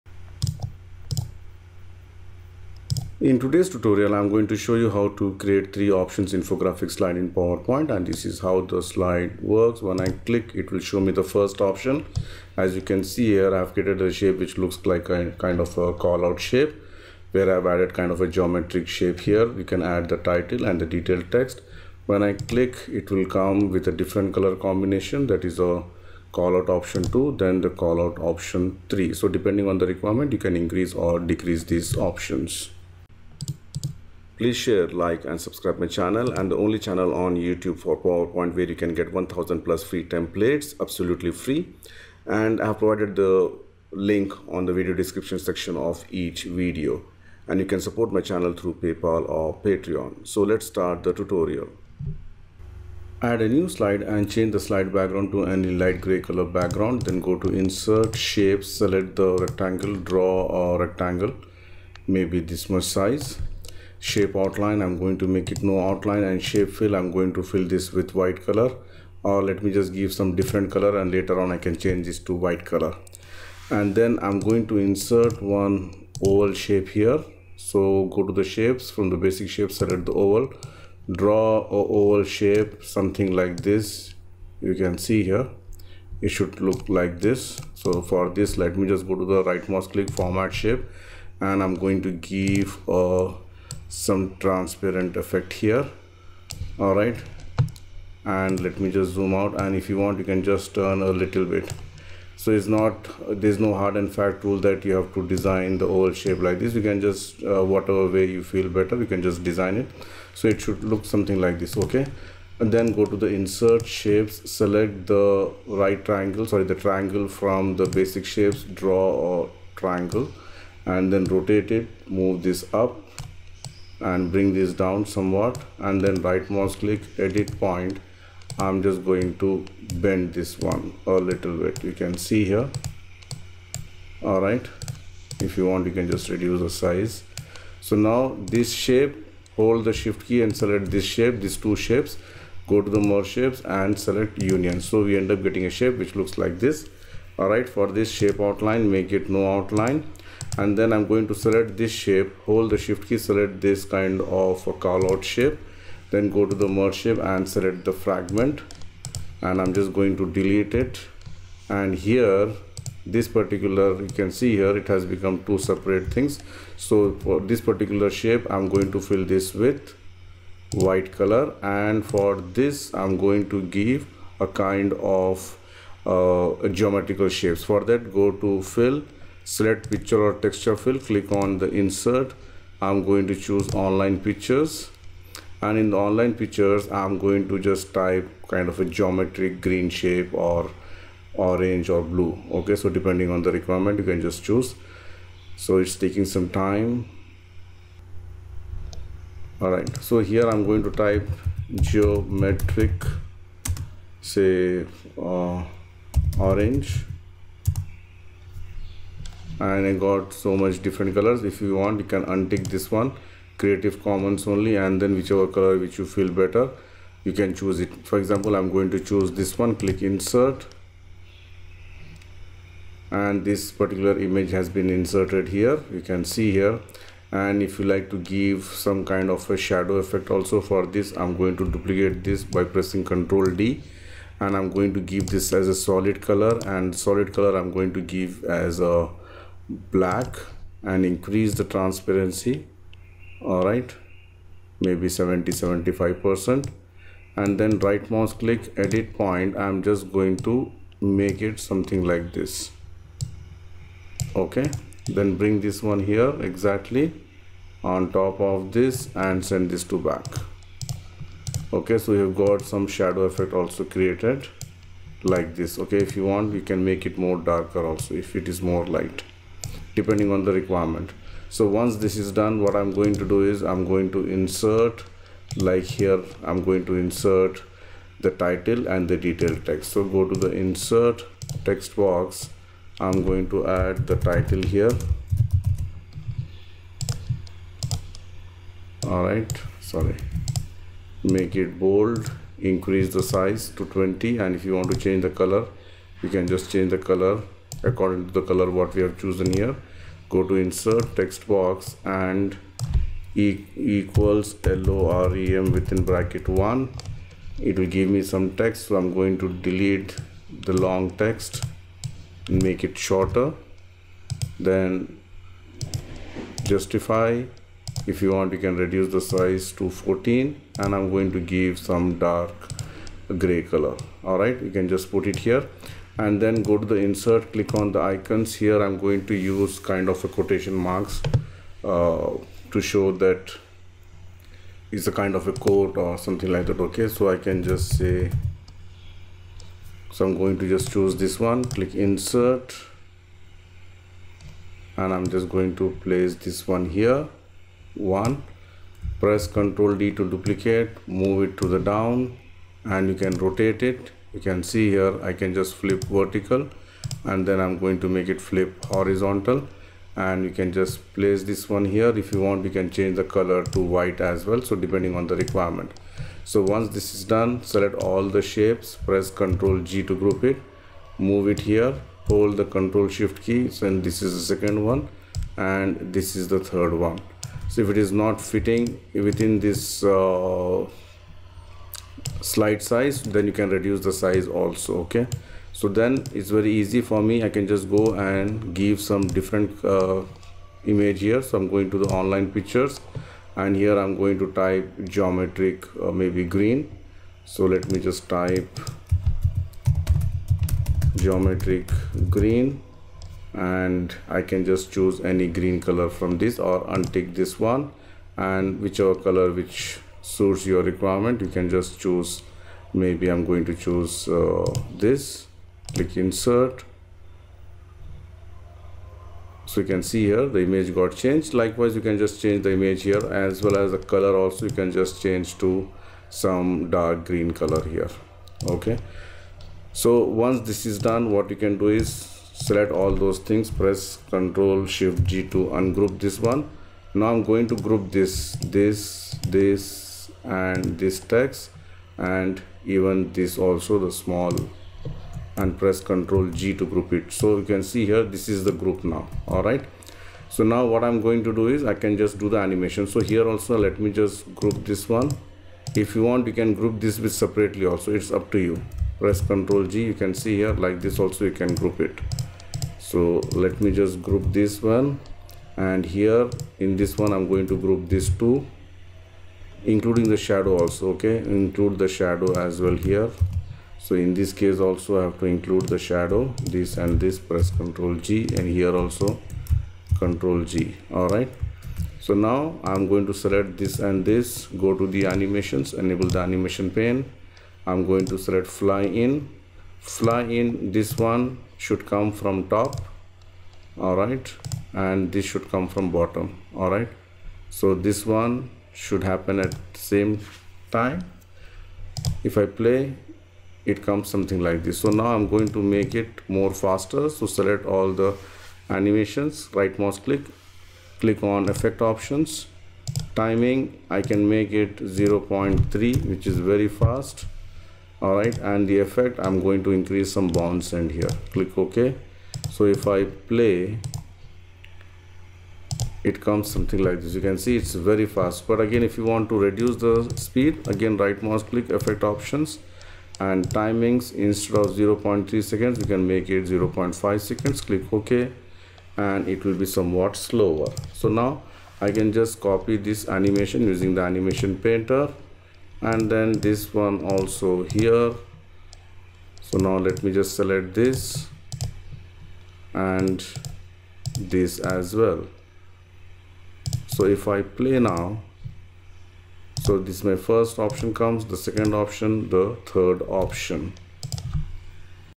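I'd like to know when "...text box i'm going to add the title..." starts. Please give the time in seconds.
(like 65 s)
281 s.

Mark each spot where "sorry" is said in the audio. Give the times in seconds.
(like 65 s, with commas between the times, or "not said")
116 s, 289 s.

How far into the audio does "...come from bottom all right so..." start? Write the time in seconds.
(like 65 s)
495 s.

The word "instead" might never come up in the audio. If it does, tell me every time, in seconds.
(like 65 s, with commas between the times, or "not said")
534 s.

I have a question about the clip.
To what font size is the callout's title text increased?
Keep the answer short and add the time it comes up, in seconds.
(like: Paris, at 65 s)
20, at 293 s.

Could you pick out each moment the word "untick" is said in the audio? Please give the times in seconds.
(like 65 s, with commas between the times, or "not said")
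212 s, 406 s.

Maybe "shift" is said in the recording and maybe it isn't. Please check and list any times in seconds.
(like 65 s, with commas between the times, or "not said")
139 s, 152 s, 373 s, 434 s.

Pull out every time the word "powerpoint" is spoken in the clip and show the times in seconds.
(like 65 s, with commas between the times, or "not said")
7 s, 37 s.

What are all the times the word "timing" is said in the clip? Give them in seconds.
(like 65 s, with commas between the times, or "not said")
513 s, 533 s.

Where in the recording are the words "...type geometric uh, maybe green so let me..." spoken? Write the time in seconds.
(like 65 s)
394 s.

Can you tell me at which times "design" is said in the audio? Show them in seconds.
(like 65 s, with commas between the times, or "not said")
105 s, 109 s.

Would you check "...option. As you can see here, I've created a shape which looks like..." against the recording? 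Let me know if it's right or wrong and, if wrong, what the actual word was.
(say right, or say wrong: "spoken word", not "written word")
right.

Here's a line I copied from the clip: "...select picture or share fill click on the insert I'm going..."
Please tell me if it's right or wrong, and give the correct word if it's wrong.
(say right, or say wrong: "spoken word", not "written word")
wrong: "texture", not "share".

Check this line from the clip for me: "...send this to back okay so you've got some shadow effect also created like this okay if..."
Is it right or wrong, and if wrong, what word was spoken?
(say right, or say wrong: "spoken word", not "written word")
right.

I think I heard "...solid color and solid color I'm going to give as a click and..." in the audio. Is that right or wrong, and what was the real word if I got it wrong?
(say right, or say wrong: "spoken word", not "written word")
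wrong: "black", not "click".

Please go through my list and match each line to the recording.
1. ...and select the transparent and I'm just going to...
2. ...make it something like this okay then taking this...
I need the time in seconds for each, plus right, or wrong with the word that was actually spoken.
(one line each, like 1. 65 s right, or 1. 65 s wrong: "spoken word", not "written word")
1. 157 s wrong: "fragment", not "transparent"
2. 250 s wrong: "bring", not "taking".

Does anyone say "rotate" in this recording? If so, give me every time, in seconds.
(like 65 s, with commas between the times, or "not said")
121 s, 353 s.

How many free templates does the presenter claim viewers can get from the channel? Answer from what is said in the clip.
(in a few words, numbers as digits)
1000 plus.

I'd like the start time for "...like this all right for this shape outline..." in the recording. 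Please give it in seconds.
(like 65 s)
146 s.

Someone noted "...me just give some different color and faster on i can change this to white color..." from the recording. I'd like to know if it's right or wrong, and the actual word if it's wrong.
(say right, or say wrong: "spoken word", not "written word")
wrong: "later", not "faster".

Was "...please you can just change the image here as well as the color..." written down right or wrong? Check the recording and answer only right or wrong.
wrong.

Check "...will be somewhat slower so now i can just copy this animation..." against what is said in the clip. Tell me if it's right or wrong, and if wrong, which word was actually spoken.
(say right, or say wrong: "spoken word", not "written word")
right.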